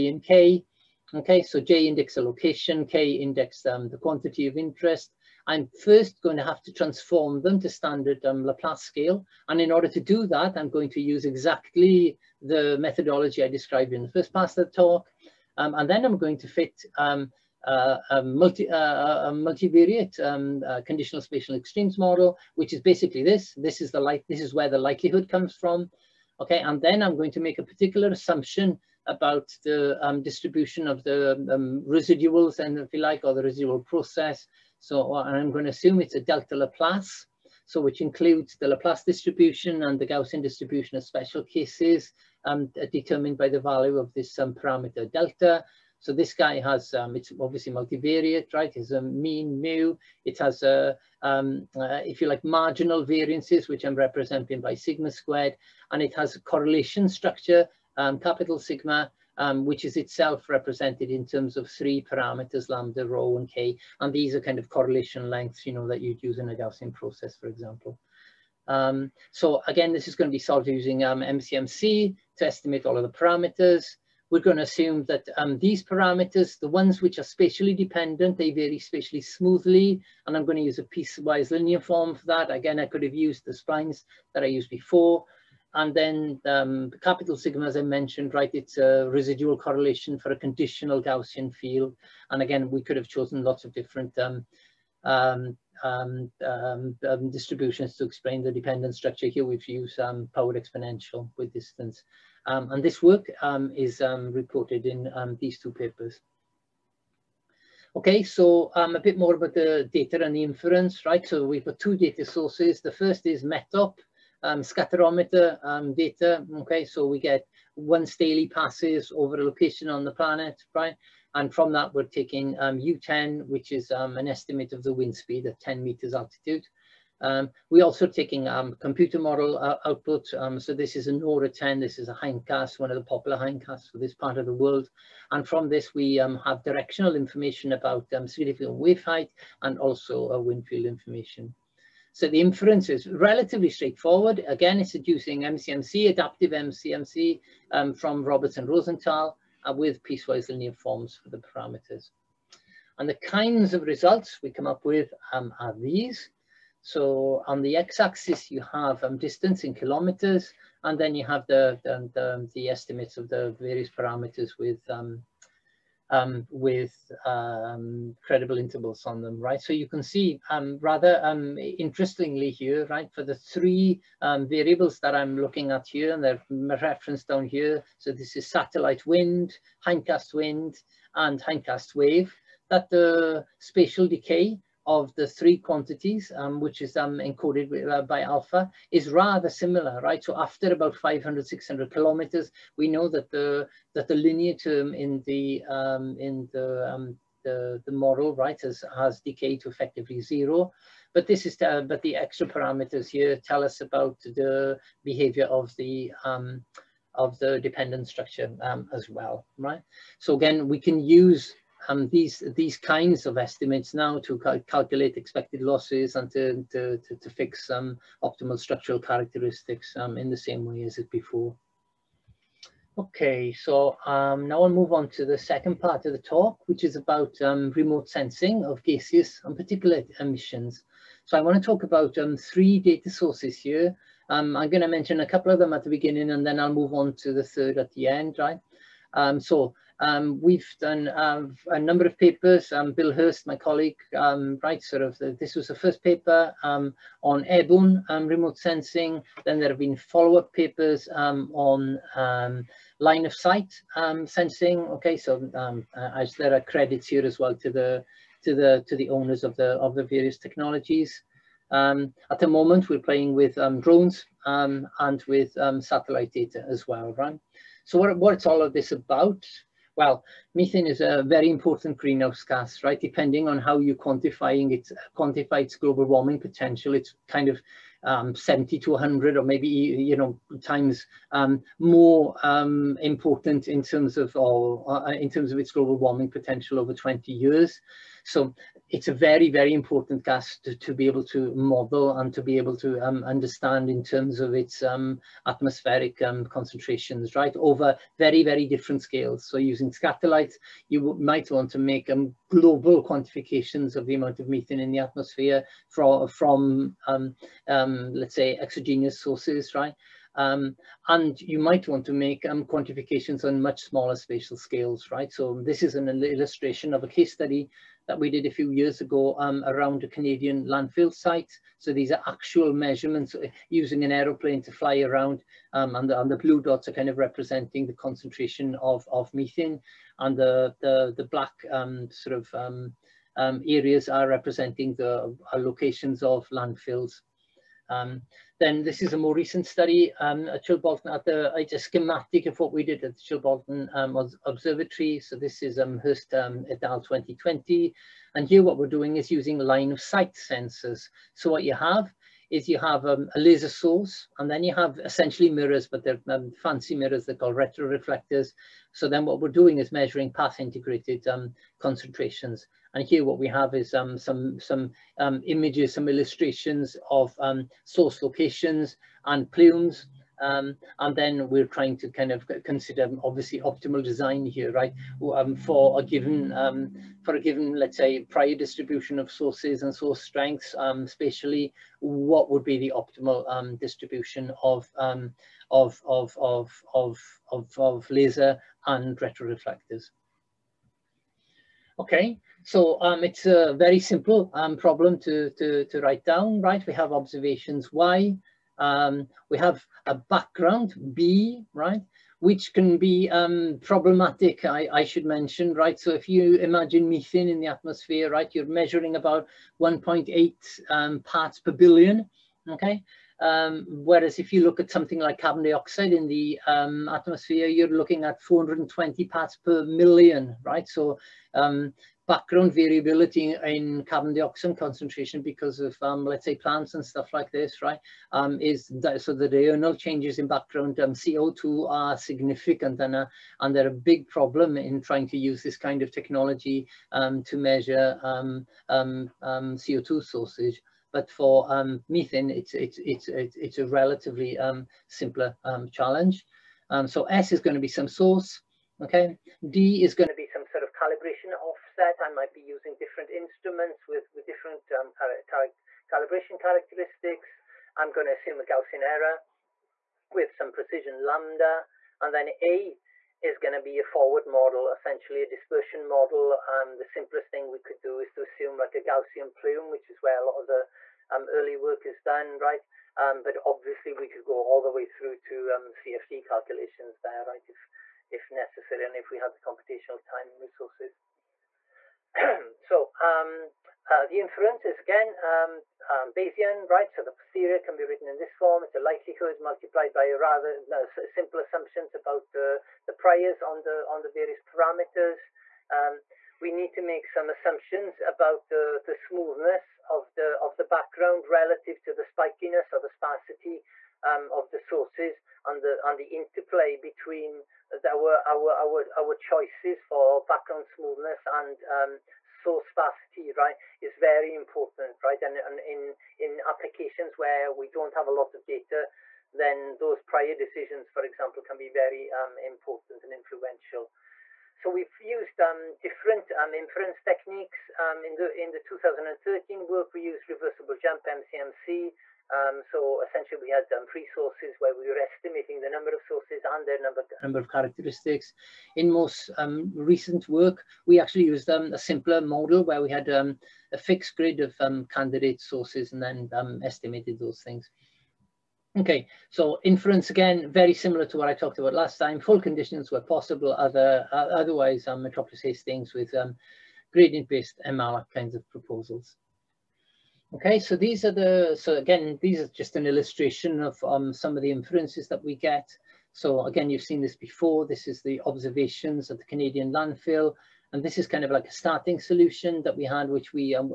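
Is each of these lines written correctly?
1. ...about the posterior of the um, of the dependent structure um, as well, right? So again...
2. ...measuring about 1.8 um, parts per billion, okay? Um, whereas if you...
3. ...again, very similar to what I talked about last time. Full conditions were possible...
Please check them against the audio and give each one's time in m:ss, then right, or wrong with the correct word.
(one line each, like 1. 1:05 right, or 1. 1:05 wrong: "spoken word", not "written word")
1. 3:23 wrong: "behavior", not "posterior"
2. 6:48 right
3. 9:10 right.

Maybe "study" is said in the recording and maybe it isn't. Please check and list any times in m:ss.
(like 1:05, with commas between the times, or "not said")
5:17, 5:39.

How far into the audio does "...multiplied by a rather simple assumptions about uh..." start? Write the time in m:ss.
8:09.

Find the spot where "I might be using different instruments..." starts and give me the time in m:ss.
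7:32.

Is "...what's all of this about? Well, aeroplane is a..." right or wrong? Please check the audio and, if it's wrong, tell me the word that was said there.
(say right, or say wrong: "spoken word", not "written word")
wrong: "methane", not "aeroplane".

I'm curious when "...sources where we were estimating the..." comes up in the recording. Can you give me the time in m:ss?
8:54.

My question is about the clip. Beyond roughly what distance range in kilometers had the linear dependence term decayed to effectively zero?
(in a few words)
500 to 600 kilometers.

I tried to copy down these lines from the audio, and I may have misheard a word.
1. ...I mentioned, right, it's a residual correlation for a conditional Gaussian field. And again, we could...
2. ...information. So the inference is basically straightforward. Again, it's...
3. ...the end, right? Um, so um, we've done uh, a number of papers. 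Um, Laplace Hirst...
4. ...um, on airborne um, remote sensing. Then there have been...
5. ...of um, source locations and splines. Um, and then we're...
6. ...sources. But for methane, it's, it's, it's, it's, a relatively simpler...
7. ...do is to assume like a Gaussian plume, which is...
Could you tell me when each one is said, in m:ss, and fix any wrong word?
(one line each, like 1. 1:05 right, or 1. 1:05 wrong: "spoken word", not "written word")
1. 1:27 right
2. 2:20 wrong: "relatively", not "basically"
3. 3:57 wrong: "Bill", not "Laplace"
4. 4:06 right
5. 6:07 wrong: "plumes", not "splines"
6. 7:20 right
7. 7:47 right.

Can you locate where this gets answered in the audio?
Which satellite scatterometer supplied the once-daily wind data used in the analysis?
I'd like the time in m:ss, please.
1:53.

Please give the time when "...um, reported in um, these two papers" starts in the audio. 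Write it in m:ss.
1:44.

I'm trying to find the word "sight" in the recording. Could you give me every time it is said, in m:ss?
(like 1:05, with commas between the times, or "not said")
4:13, 5:50.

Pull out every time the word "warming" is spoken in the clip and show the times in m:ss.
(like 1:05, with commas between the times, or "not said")
4:36, 4:45.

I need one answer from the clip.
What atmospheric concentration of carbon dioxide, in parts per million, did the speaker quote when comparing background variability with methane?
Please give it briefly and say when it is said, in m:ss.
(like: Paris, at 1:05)
420, at 6:58.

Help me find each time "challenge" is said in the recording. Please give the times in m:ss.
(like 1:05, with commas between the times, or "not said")
7:25.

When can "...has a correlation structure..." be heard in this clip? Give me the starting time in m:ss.
0:56.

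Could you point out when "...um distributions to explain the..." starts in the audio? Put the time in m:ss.
1:37.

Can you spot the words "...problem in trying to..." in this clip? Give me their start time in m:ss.
7:14.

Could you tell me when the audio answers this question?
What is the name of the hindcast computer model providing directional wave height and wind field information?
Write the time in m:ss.
2:11.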